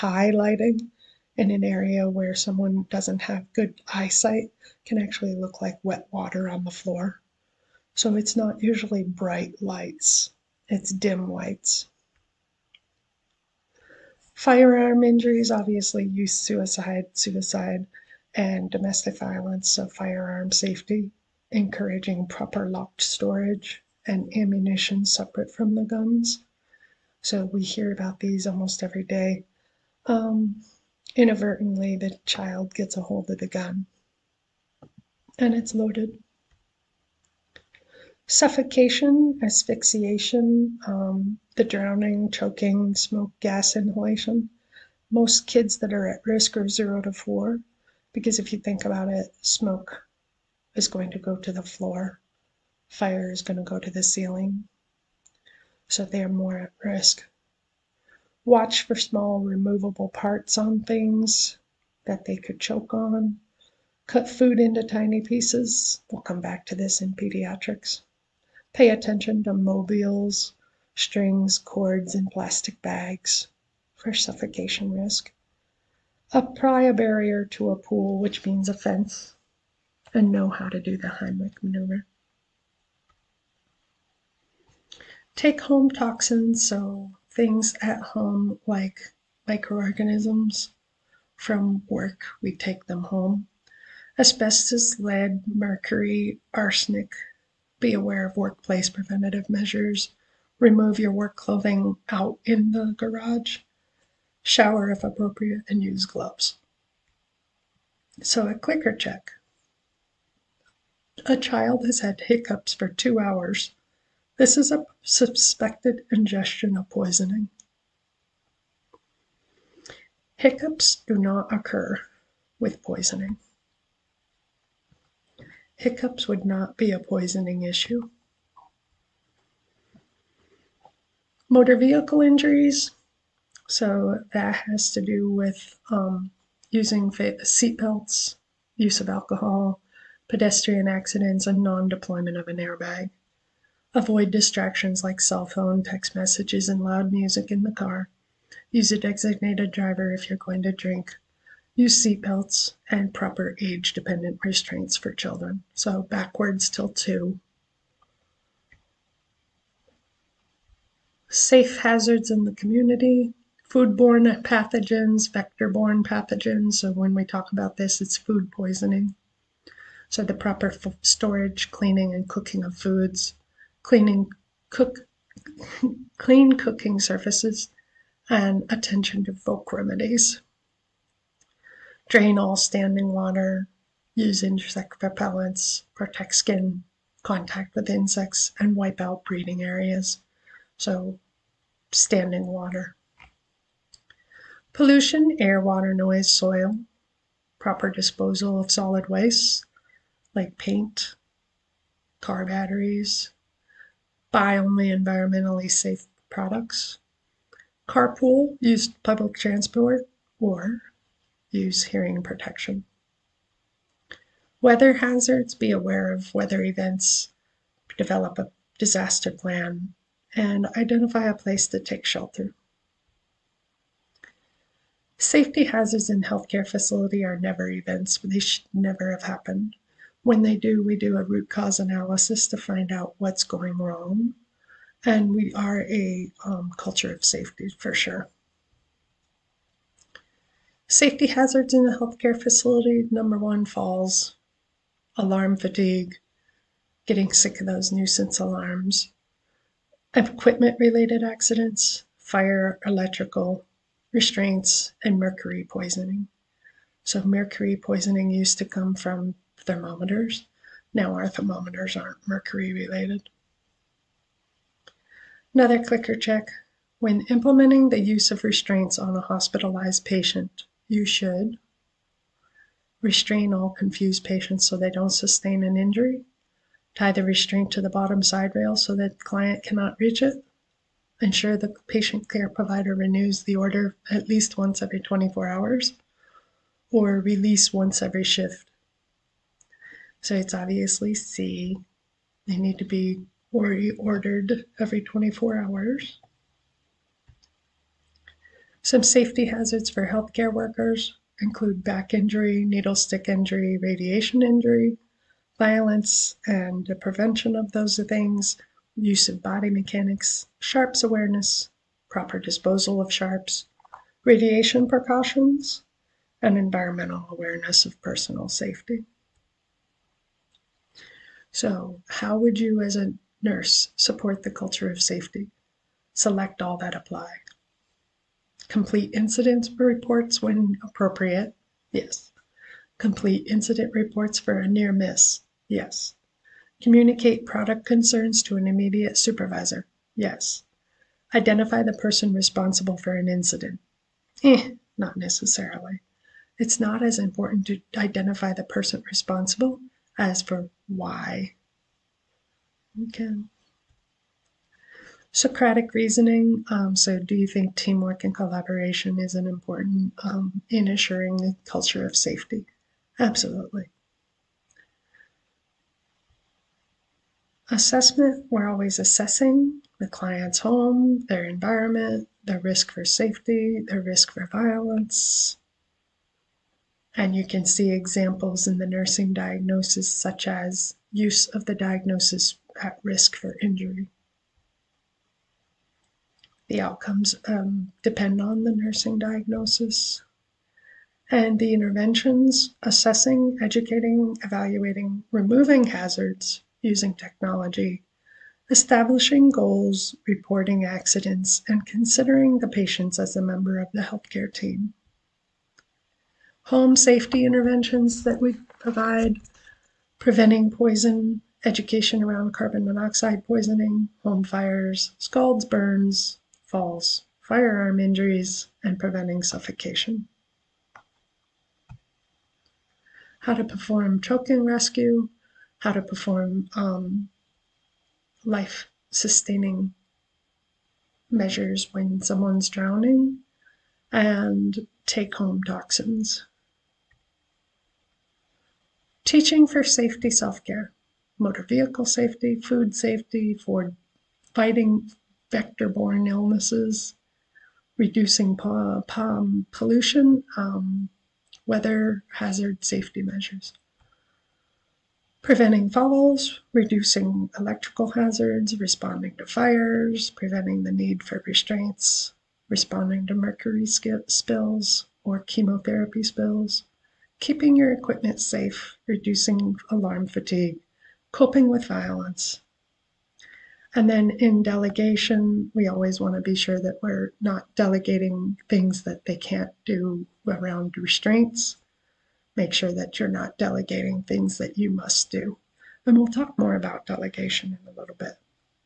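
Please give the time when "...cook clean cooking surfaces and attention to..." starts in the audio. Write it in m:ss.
2:54.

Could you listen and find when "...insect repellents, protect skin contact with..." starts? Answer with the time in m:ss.
3:04.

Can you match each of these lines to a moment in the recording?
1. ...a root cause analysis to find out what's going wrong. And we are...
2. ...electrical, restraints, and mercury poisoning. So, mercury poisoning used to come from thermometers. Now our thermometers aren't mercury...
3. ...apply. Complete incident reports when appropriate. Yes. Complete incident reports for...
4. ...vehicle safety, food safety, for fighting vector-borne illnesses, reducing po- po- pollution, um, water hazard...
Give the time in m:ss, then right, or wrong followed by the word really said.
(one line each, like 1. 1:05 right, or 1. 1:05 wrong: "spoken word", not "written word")
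1. 3:51 right
2. 4:12 right
3. 5:26 right
4. 7:21 wrong: "weather", not "water".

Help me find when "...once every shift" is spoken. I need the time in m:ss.
4:47.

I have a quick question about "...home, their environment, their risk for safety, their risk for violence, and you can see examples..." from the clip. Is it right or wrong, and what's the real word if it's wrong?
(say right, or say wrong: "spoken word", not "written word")
right.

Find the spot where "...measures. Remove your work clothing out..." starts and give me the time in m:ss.
1:39.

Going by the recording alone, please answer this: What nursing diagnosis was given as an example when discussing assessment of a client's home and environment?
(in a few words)
At risk for injury.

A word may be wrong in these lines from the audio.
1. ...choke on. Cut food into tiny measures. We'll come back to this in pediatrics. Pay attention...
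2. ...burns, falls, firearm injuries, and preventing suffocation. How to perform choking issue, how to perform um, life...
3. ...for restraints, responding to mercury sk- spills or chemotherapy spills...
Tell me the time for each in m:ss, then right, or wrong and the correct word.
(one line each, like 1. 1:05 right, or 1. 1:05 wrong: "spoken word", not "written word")
1. 1:02 wrong: "pieces", not "measures"
2. 6:55 wrong: "rescue", not "issue"
3. 7:41 right.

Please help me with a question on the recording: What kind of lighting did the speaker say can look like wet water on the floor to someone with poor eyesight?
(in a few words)
Dim lights.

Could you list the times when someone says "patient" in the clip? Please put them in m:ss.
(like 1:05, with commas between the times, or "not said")
4:30, 4:34, 4:41, 6:42.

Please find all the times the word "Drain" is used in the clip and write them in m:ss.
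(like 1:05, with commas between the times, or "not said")
3:02.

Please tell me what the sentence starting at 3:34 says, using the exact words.
Weather hazards, be aware of weather events, develop a disaster plan, and identify a place to take shelter.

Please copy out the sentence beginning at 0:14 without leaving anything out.
Firearm injuries, obviously, youth suicide, suicide, and domestic violence, so firearm safety, encouraging proper locked storage, and ammunition separate from the guns.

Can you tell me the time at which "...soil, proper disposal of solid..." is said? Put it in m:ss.
3:16.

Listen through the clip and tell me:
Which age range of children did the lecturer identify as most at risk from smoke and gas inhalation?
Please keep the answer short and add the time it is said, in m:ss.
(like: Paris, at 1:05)
0 to 4, at 0:46.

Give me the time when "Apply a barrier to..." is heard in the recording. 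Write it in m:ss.
1:16.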